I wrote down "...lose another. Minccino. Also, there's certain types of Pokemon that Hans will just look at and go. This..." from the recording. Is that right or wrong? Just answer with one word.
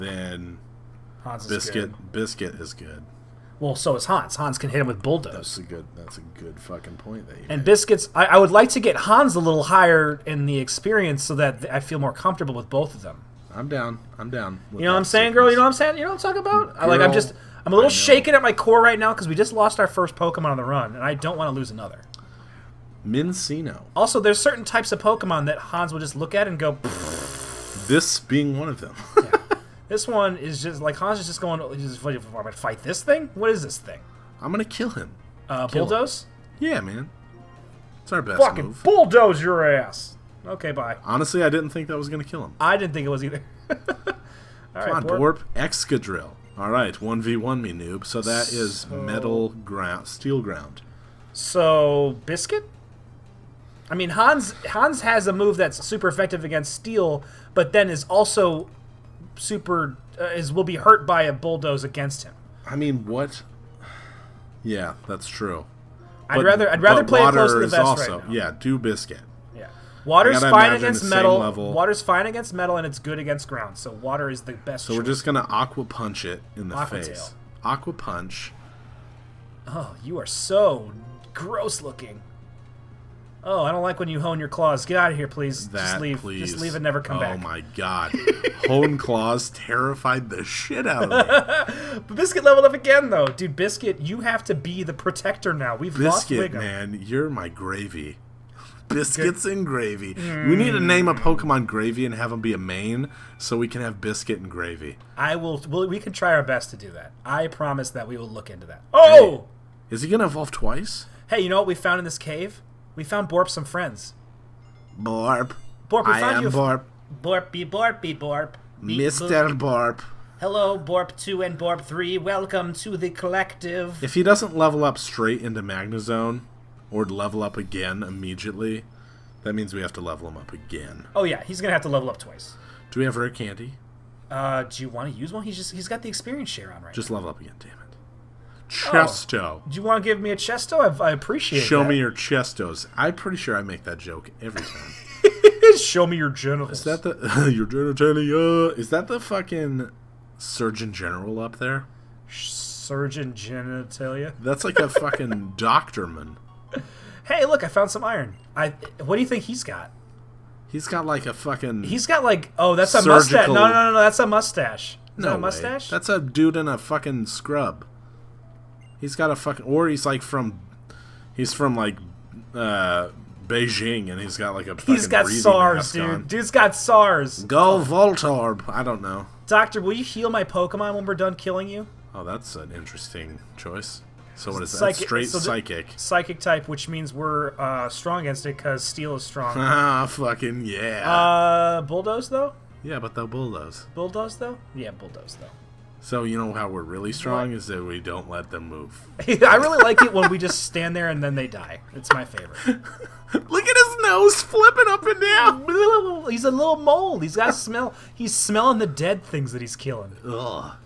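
right.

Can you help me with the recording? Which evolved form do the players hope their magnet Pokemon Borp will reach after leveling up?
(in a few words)
Magnezone.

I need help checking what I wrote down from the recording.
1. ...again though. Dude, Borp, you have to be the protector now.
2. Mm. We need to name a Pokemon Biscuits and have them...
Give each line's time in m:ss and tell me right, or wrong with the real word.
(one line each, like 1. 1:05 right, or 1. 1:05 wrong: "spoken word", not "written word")
1. 1:32 wrong: "Biscuit", not "Borp"
2. 1:40 wrong: "Gravy", not "Biscuits".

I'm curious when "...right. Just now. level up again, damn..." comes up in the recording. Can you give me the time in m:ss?
2:16.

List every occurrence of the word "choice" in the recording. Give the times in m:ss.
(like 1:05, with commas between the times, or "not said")
1:14, 3:03.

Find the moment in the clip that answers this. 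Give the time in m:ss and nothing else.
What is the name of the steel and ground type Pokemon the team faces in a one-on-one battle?
0:45.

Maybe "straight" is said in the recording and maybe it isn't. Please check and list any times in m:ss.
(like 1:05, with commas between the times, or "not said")
2:04, 3:05.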